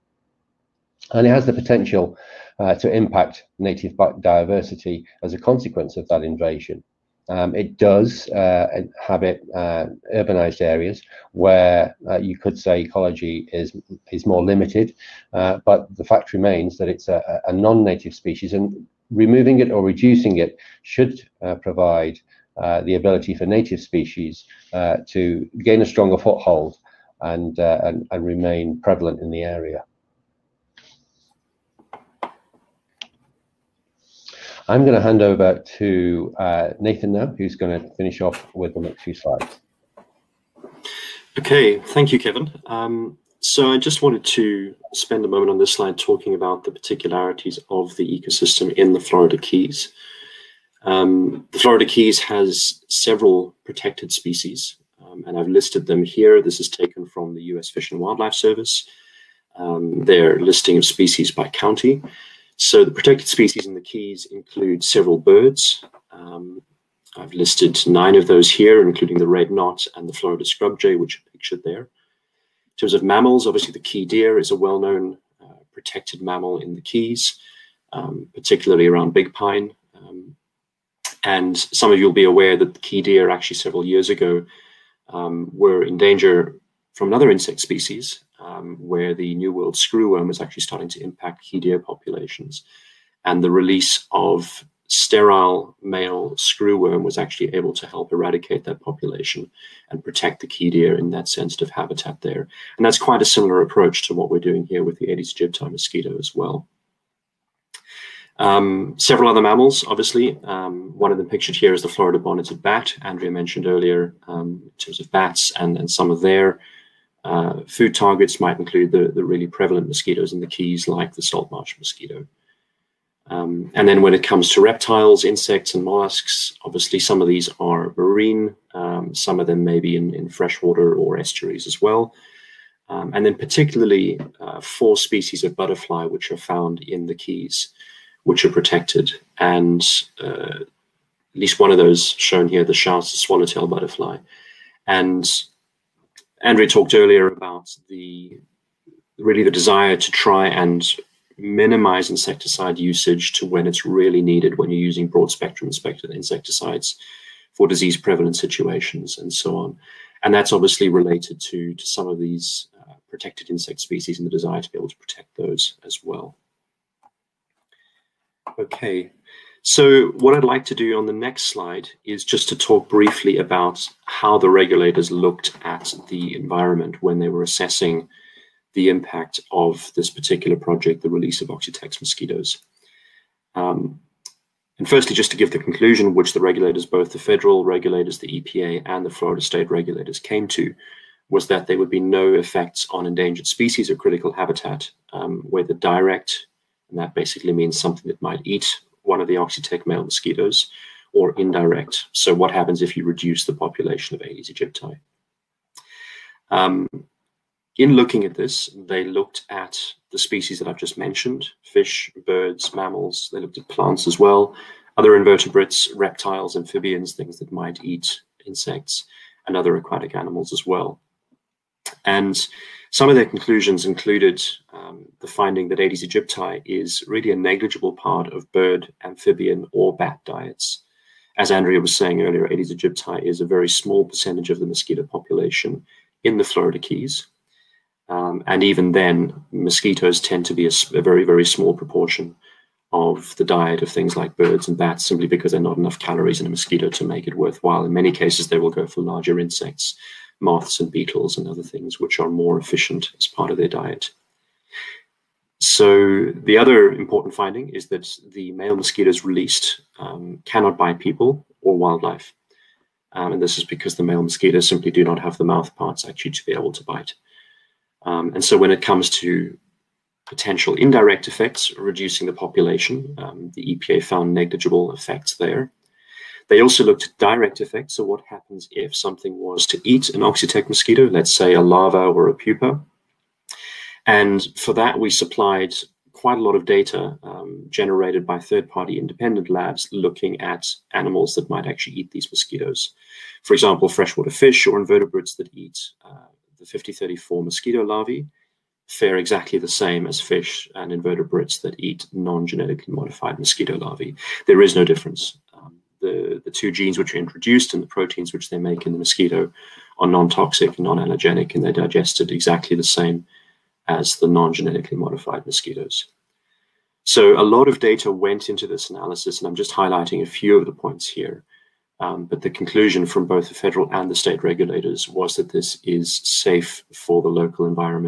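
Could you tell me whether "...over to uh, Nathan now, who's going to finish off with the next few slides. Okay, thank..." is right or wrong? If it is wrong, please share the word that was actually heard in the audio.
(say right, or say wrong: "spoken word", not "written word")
right.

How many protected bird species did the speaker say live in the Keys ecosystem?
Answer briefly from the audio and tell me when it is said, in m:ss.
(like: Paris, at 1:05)
9, at 1:07.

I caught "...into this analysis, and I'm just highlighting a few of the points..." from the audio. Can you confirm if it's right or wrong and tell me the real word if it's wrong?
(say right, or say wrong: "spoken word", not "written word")
right.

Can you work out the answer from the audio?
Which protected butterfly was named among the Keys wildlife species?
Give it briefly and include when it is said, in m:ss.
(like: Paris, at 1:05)
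Schaus swallowtail, at 2:22.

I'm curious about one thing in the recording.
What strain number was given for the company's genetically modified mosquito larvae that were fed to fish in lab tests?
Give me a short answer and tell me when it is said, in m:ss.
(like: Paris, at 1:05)
5034, at 4:56.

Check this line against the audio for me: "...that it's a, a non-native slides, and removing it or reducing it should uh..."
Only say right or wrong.
wrong.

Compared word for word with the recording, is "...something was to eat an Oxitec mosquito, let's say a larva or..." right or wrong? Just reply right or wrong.
right.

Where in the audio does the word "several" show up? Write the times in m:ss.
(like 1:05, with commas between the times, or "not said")
0:52, 1:04, 1:23, 1:48.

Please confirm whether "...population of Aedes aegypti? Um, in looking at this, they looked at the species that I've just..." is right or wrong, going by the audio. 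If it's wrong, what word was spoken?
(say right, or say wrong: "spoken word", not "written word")
right.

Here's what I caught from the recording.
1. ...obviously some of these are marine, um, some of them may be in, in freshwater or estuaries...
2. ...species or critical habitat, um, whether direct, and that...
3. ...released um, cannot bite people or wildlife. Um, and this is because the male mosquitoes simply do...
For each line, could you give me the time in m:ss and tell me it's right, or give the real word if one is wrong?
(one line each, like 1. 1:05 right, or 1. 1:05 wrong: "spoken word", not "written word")
1. 2:06 right
2. 3:13 right
3. 4:19 right.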